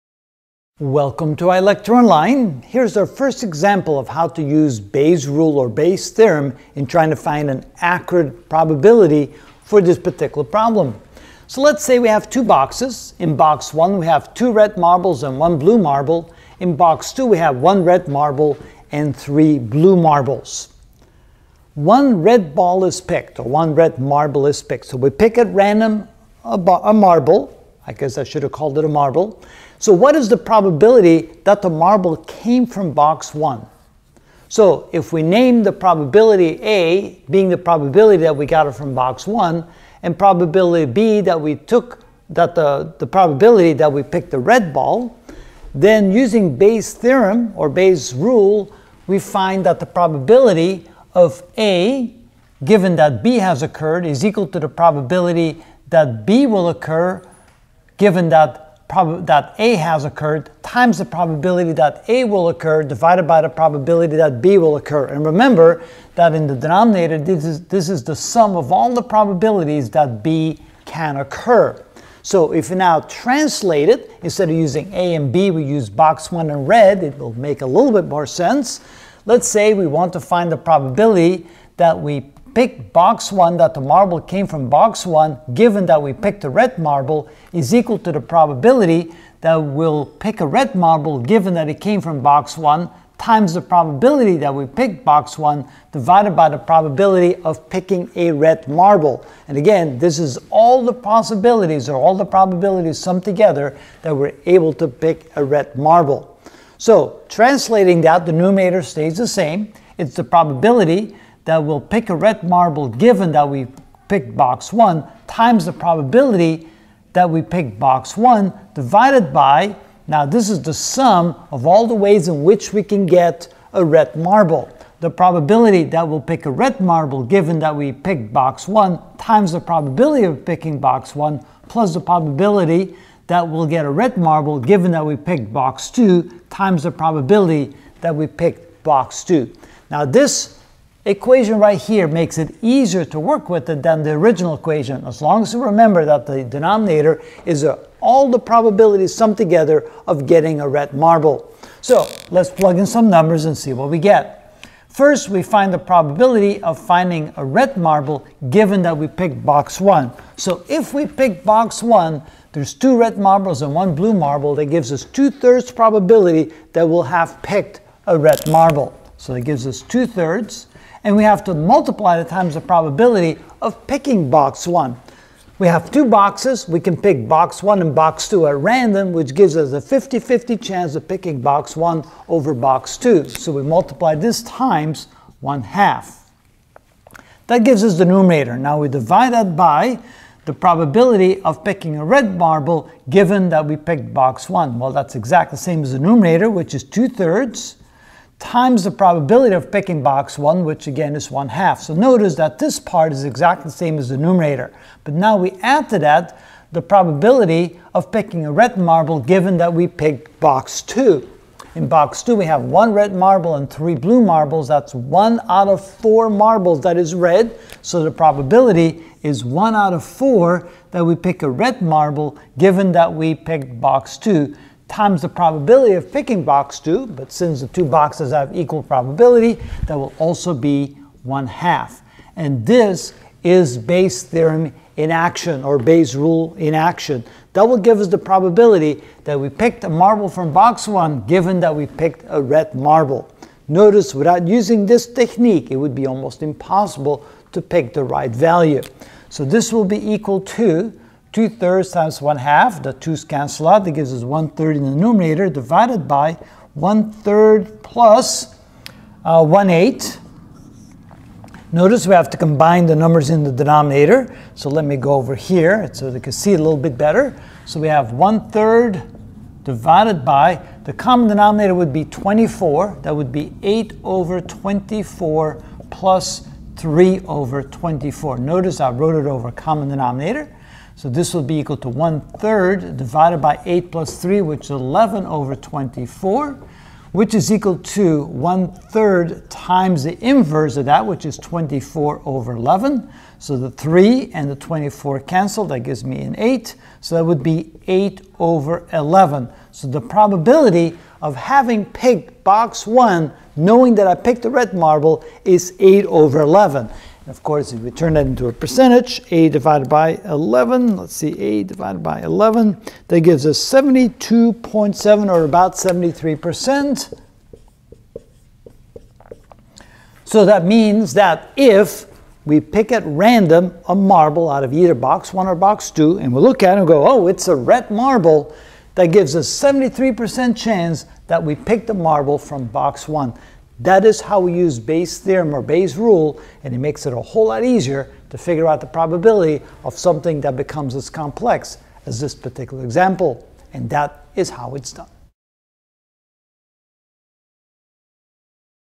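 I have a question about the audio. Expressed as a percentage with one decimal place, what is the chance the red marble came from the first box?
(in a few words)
72.7%.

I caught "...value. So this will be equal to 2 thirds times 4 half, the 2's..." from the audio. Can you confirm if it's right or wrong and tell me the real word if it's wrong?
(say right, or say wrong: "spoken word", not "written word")
wrong: "1", not "4".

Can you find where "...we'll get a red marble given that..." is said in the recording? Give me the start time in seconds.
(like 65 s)
133 s.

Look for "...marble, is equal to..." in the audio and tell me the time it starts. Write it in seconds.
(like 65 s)
86 s.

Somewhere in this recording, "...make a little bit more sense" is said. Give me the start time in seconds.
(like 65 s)
77 s.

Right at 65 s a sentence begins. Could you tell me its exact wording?
And remember that in the denominator, this is, this is the sum of all the probabilities that B can occur.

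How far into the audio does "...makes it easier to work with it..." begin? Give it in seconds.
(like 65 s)
142 s.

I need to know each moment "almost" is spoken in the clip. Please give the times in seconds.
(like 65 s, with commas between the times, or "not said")
246 s.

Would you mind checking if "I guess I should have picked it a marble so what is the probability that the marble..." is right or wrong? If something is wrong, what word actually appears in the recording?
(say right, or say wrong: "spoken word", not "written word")
wrong: "called", not "picked".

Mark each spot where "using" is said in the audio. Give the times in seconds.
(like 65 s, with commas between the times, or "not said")
46 s, 74 s, 244 s.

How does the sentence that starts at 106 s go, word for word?
So translating that, the numerator stays the same.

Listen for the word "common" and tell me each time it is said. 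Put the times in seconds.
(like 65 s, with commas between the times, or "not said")
270 s, 279 s.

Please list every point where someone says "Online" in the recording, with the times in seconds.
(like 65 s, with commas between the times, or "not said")
1 s.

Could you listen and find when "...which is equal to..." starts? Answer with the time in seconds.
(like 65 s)
287 s.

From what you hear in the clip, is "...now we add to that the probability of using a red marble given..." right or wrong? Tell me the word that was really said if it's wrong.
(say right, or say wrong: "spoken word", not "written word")
wrong: "picking", not "using".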